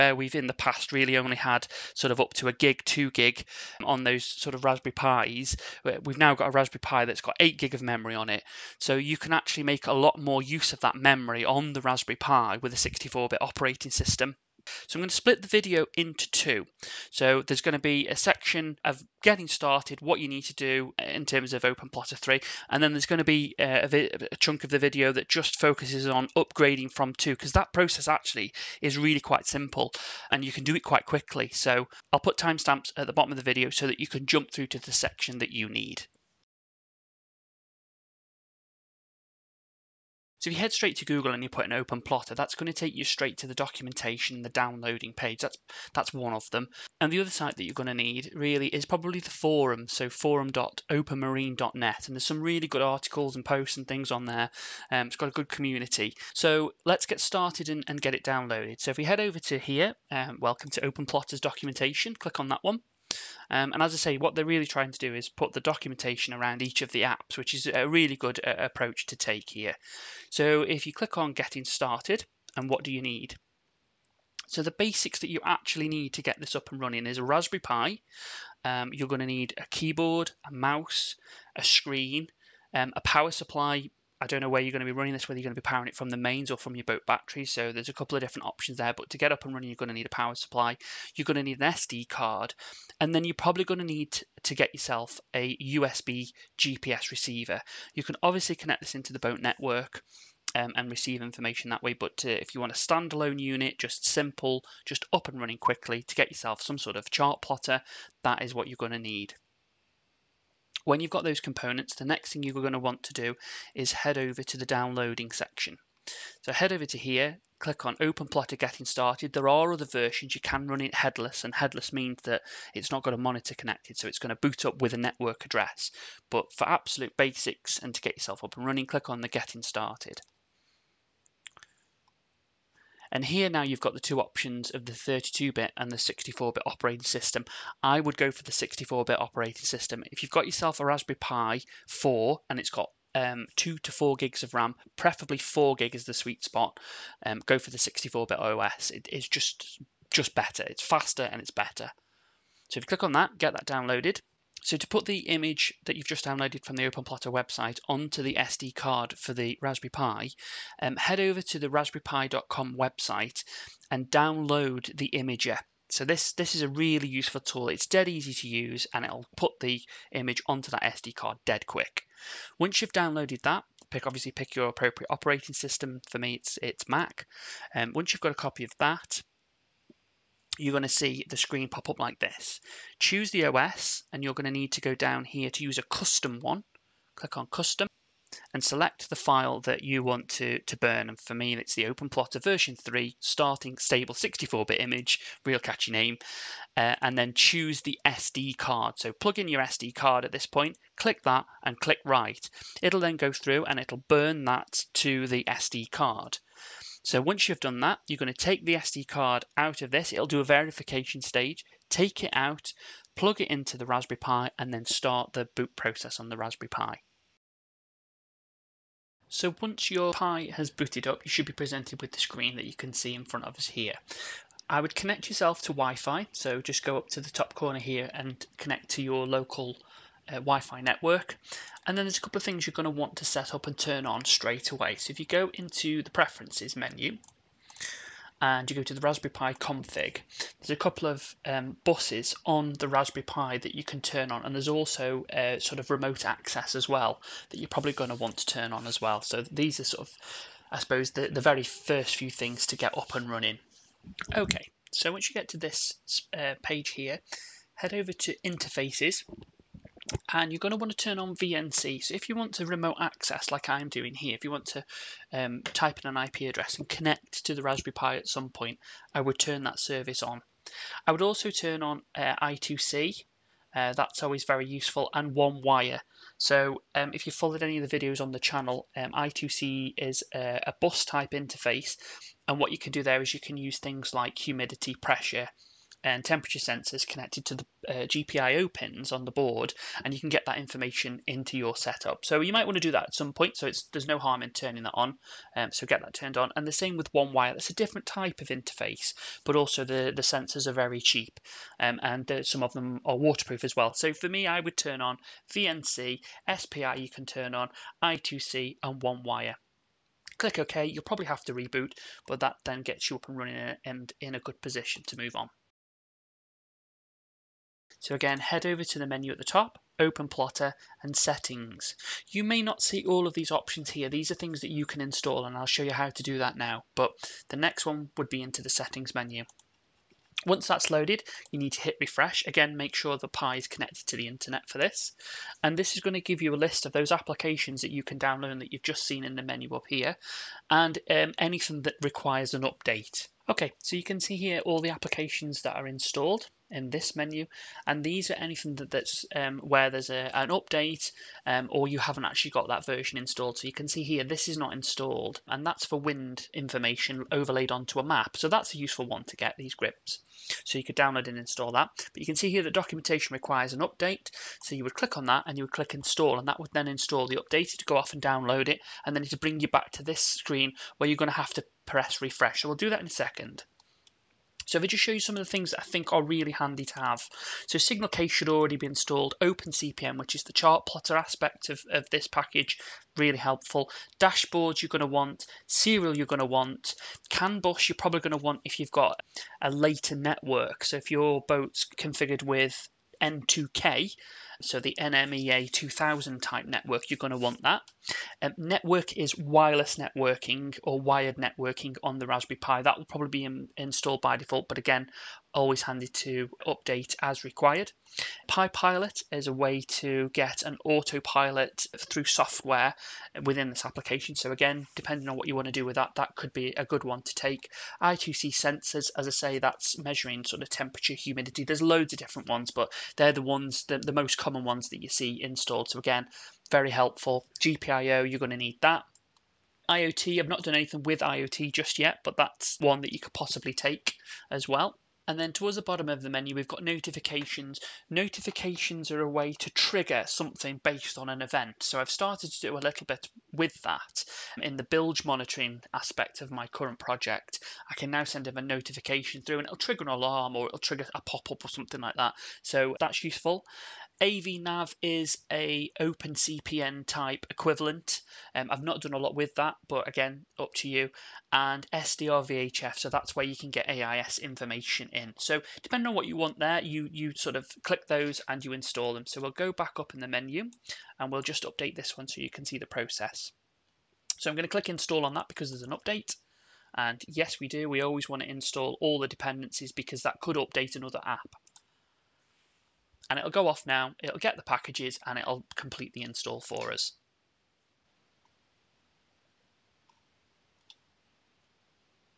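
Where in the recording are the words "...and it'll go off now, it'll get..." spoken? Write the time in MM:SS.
08:03.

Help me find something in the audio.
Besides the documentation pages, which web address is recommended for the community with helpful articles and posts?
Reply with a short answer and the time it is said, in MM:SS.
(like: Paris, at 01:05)
forum.openmarine.net, at 00:50.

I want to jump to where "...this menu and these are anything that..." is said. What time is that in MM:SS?
05:46.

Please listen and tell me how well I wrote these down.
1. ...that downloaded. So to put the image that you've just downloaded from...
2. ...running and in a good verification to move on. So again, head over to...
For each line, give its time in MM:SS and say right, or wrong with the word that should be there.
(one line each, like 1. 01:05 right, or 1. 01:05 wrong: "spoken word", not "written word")
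1. 02:33 right
2. 05:13 wrong: "position", not "verification".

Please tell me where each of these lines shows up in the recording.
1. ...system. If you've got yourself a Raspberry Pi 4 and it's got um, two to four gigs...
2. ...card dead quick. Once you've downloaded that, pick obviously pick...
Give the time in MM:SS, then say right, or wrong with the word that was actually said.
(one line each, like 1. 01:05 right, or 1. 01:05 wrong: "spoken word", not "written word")
1. 02:19 right
2. 02:51 right.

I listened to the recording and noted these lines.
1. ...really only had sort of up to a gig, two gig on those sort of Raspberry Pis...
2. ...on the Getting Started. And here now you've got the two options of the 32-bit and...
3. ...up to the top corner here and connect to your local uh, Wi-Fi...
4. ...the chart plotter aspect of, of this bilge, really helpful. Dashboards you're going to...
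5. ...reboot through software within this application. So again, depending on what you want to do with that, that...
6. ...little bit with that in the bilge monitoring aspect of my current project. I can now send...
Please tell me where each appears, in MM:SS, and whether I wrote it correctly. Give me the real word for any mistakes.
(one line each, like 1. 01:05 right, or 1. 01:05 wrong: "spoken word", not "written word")
1. 00:00 right
2. 02:09 right
3. 03:46 right
4. 06:20 wrong: "package", not "bilge"
5. 06:50 wrong: "autopilot", not "reboot"
6. 07:22 right.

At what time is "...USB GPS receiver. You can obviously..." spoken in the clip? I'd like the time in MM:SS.
01:35.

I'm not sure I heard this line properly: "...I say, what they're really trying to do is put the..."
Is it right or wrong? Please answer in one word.
right.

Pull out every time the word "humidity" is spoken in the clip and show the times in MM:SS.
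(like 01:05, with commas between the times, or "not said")
04:44, 07:01.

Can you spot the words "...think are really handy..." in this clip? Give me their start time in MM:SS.
06:15.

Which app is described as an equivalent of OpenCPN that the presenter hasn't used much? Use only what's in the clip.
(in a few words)
AVNav.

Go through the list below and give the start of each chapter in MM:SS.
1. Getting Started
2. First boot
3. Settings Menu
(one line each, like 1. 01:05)
1. 00:36
2. 03:36
3. 05:15.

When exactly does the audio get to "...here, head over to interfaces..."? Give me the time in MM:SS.
04:16.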